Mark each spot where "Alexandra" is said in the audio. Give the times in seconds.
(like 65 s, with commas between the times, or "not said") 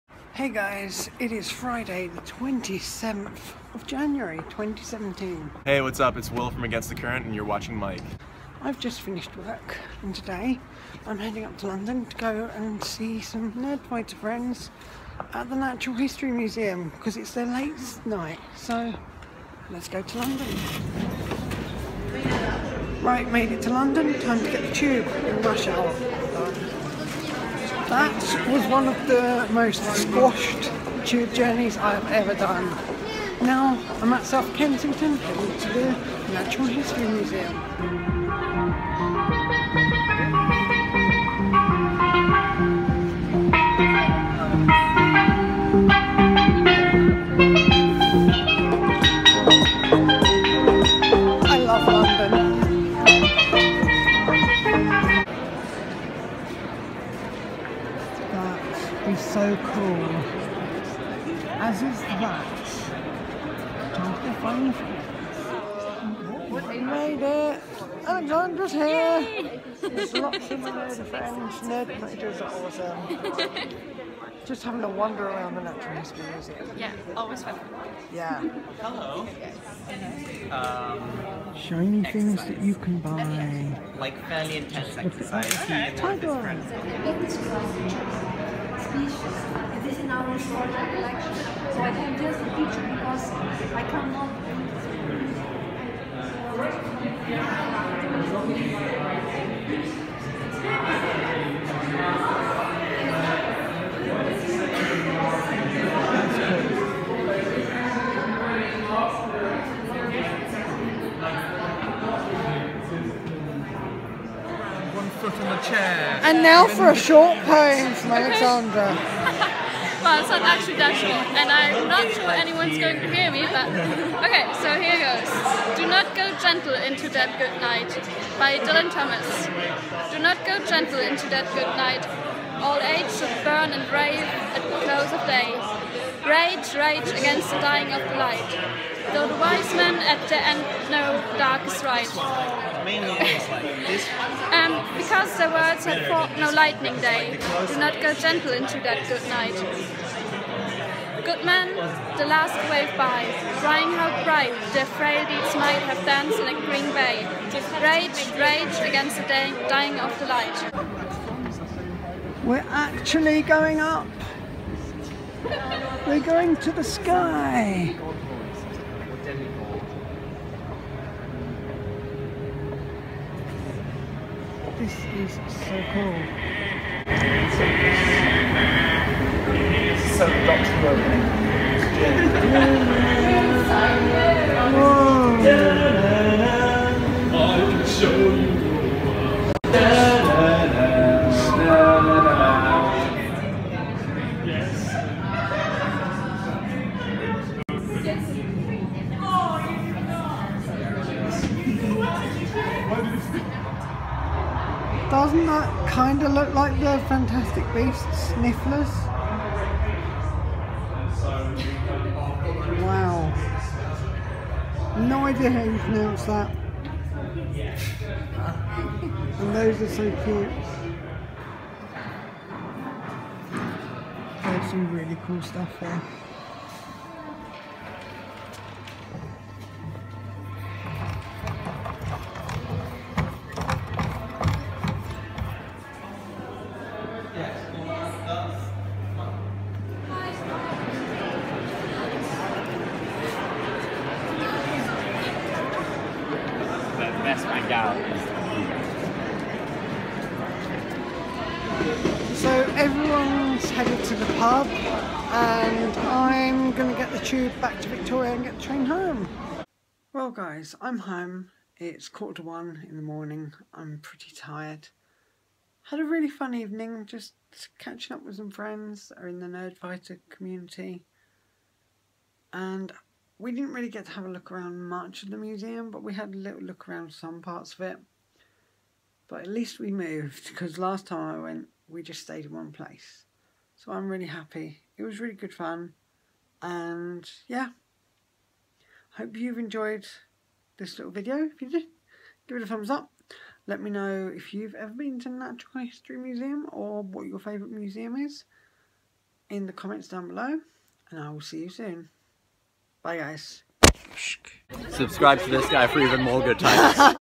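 68 s, 118 s.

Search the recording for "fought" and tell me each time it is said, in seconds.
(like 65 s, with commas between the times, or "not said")
146 s.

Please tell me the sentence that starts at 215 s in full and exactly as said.
No idea how you pronounce that.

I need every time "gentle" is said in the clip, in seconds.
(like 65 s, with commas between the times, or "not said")
126 s, 130 s, 148 s.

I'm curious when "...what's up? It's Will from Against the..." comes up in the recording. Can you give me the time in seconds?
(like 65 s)
5 s.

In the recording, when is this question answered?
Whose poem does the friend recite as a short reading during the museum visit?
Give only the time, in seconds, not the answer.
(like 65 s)
128 s.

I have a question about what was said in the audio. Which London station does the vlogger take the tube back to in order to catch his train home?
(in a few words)
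Victoria.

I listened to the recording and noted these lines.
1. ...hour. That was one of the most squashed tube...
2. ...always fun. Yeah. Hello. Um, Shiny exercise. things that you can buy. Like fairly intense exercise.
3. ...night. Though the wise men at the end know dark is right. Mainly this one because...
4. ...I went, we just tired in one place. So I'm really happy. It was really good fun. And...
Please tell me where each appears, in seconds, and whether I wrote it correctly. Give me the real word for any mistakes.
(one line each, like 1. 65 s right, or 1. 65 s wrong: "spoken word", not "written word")
1. 25 s right
2. 77 s right
3. 138 s wrong: "light", not "night"
4. 281 s wrong: "stayed", not "tired".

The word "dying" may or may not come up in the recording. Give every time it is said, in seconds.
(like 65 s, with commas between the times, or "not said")
137 s, 159 s.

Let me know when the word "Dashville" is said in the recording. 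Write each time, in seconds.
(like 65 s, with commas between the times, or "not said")
120 s.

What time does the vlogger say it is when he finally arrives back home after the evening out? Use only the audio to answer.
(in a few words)
quarter to one in the morning.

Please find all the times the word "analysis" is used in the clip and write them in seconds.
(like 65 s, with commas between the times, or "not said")
not said.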